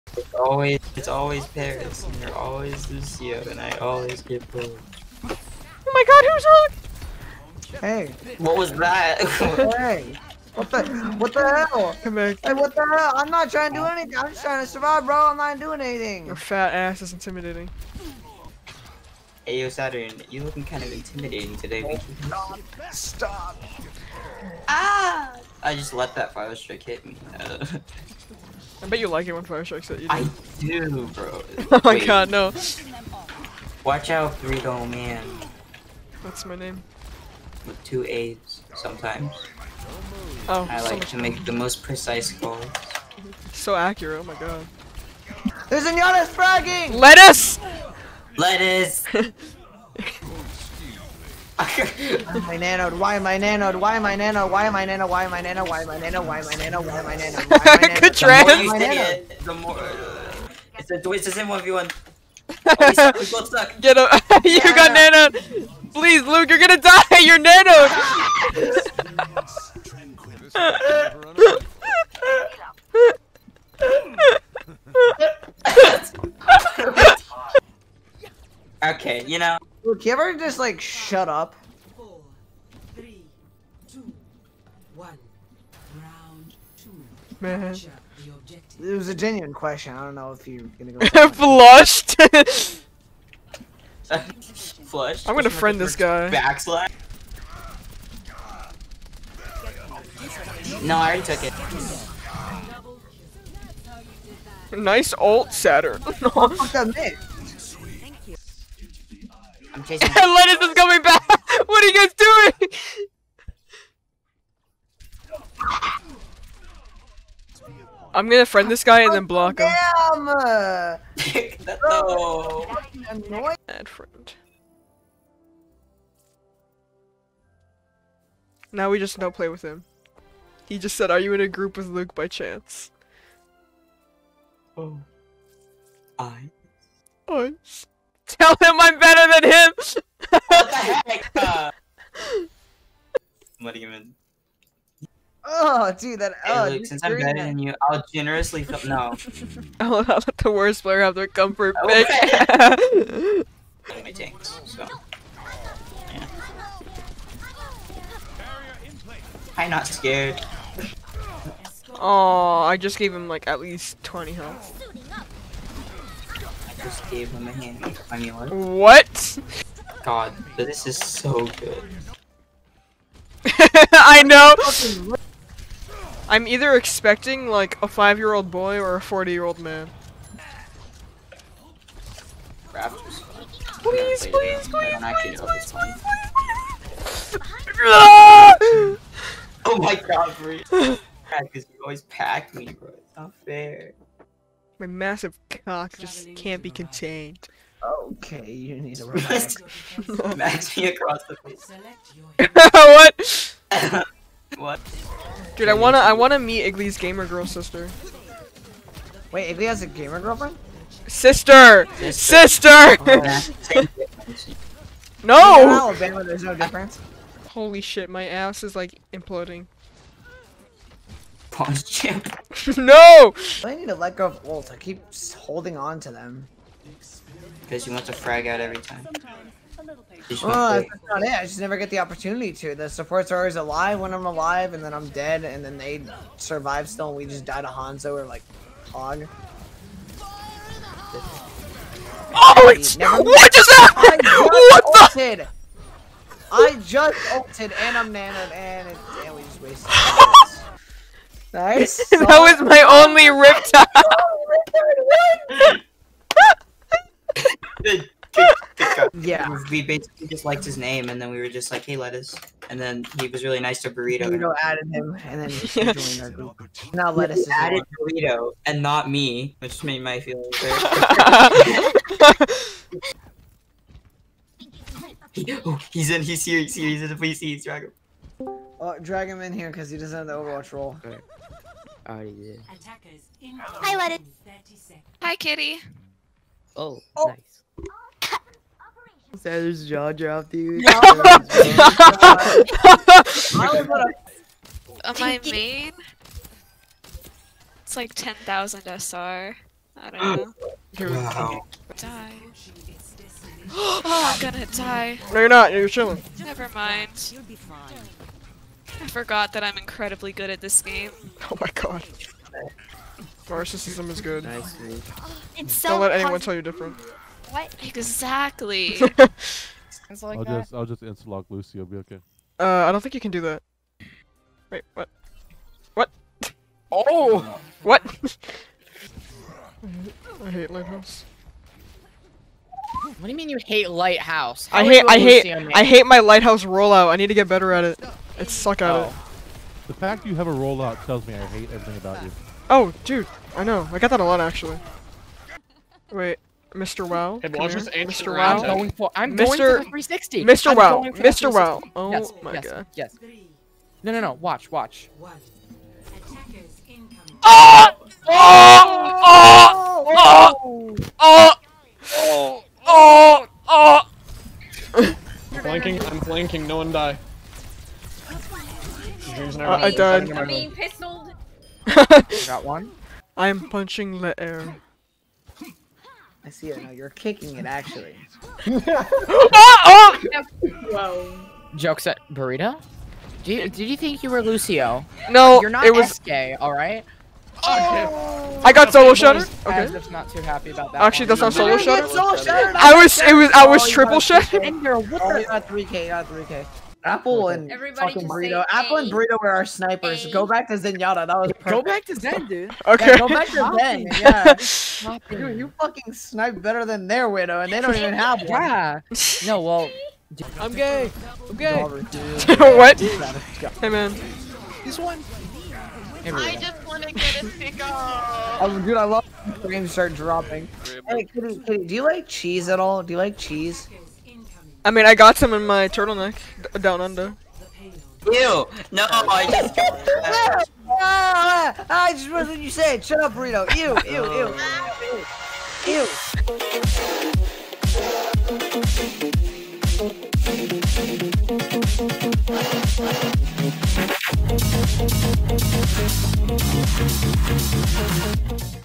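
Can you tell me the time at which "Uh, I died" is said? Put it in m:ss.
6:09.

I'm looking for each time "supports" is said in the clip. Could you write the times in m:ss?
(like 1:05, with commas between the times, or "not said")
3:52.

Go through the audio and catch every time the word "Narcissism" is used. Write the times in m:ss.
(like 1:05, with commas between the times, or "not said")
5:13.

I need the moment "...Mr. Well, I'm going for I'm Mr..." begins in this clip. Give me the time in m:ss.
5:47.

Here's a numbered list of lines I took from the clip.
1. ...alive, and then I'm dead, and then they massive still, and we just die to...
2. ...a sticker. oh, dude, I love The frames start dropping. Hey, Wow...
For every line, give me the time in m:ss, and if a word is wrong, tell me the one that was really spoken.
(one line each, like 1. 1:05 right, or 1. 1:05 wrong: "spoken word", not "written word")
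1. 3:54 wrong: "survive", not "massive"
2. 6:57 wrong: "Kitty", not "Wow".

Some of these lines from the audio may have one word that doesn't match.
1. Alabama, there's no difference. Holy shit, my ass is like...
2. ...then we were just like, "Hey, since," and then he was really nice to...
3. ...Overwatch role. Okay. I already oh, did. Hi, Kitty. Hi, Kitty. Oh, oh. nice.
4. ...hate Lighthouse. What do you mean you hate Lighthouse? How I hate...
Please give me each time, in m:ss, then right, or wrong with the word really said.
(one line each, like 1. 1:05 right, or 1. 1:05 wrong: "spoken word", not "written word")
1. 3:35 right
2. 4:21 wrong: "lettuce", not "since"
3. 4:40 wrong: "Lettuce", not "Kitty"
4. 5:30 right.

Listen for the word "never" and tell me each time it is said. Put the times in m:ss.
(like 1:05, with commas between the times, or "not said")
3:51, 4:02, 5:06.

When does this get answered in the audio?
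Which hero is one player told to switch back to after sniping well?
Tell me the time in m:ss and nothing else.
6:40.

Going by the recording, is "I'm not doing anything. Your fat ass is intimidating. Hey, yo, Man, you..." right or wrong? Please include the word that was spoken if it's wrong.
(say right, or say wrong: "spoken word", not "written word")
wrong: "Saturn", not "Man".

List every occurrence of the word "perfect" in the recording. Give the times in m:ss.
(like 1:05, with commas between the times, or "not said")
6:41.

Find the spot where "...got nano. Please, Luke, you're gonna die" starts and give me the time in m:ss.
1:04.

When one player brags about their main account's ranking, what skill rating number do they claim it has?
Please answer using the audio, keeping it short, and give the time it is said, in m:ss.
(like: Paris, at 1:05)
10,000 SR, at 4:58.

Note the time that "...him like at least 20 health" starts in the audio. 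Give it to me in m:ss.
2:43.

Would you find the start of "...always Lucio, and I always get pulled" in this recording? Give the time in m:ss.
0:02.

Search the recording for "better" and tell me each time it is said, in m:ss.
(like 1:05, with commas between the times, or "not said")
2:18, 2:27, 5:37, 6:46.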